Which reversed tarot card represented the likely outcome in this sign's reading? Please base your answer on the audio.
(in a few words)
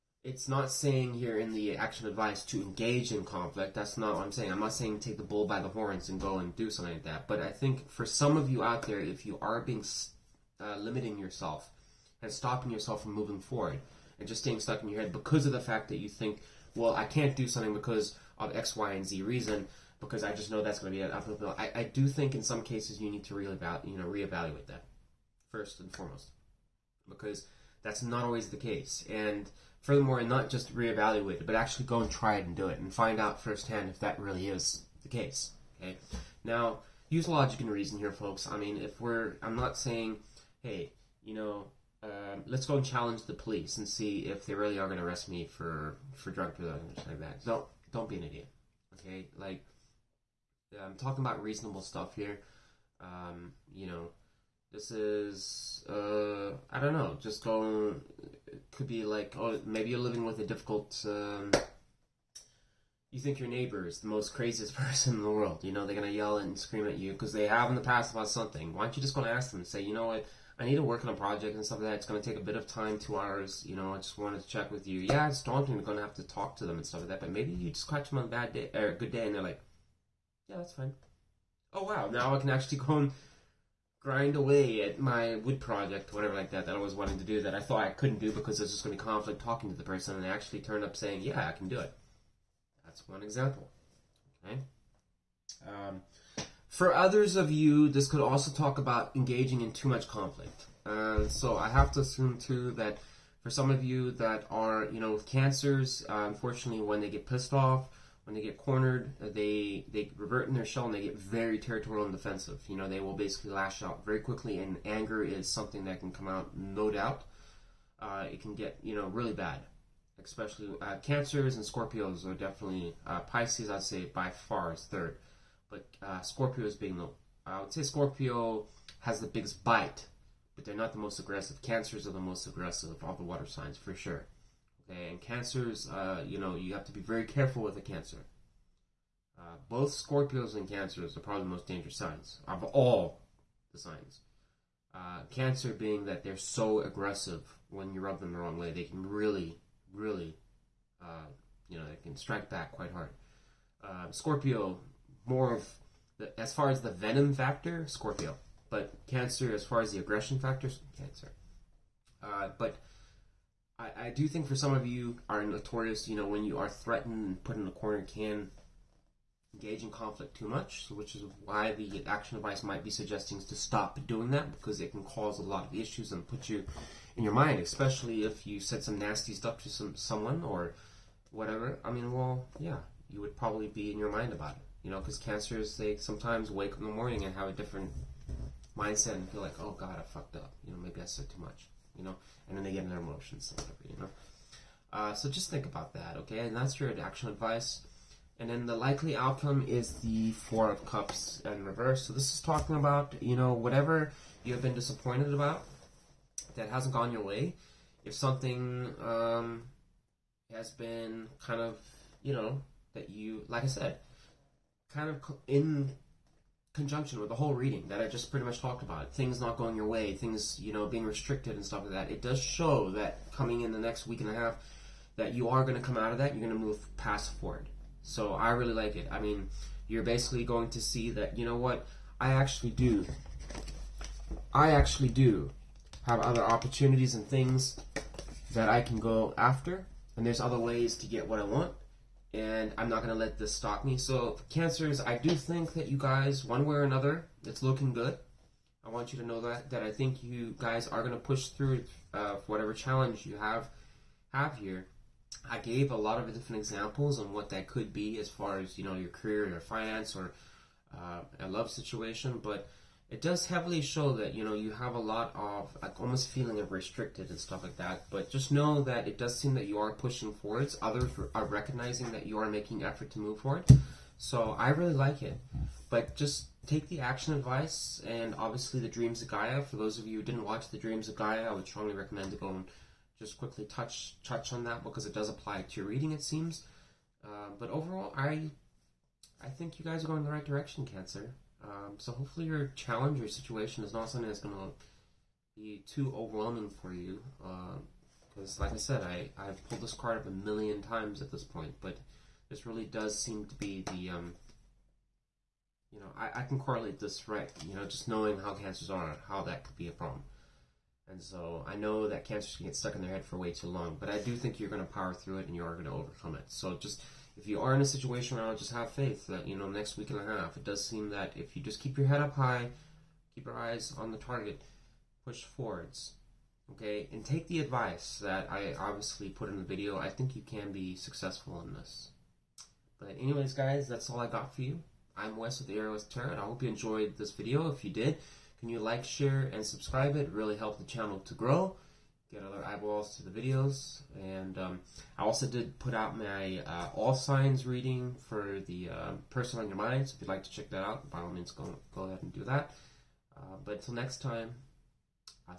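Four of Cups.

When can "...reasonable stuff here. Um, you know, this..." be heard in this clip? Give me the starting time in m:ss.
0:51.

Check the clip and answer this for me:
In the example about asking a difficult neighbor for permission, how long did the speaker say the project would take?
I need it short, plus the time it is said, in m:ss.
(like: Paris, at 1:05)
2 hours, at 1:12.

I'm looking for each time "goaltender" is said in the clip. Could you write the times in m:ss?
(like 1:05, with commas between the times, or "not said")
not said.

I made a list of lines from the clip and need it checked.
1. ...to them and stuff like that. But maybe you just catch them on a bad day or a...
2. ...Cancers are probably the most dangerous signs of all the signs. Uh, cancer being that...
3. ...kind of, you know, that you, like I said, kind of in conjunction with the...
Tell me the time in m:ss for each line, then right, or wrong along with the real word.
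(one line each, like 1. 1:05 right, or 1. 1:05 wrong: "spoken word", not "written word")
1. 1:16 right
2. 2:20 right
3. 3:31 right.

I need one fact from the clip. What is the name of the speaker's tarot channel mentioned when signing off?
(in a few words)
Aurawest Tarot.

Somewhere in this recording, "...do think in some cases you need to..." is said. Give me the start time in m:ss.
0:21.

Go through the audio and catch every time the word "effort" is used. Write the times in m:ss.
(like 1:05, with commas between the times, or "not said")
4:32.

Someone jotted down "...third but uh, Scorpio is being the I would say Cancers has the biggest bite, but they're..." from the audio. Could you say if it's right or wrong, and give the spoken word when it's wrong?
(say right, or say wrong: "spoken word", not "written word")
wrong: "Scorpio", not "Cancers".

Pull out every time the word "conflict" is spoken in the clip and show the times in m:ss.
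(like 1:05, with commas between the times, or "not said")
0:03, 1:29, 1:40, 2:49.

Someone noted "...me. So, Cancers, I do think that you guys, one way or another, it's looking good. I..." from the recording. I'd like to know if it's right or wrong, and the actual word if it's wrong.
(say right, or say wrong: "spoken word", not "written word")
right.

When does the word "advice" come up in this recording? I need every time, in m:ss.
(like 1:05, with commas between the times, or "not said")
0:02, 2:52, 3:17, 4:37, 5:27.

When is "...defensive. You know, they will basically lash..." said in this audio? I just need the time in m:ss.
1:52.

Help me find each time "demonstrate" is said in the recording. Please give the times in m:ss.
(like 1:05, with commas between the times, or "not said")
not said.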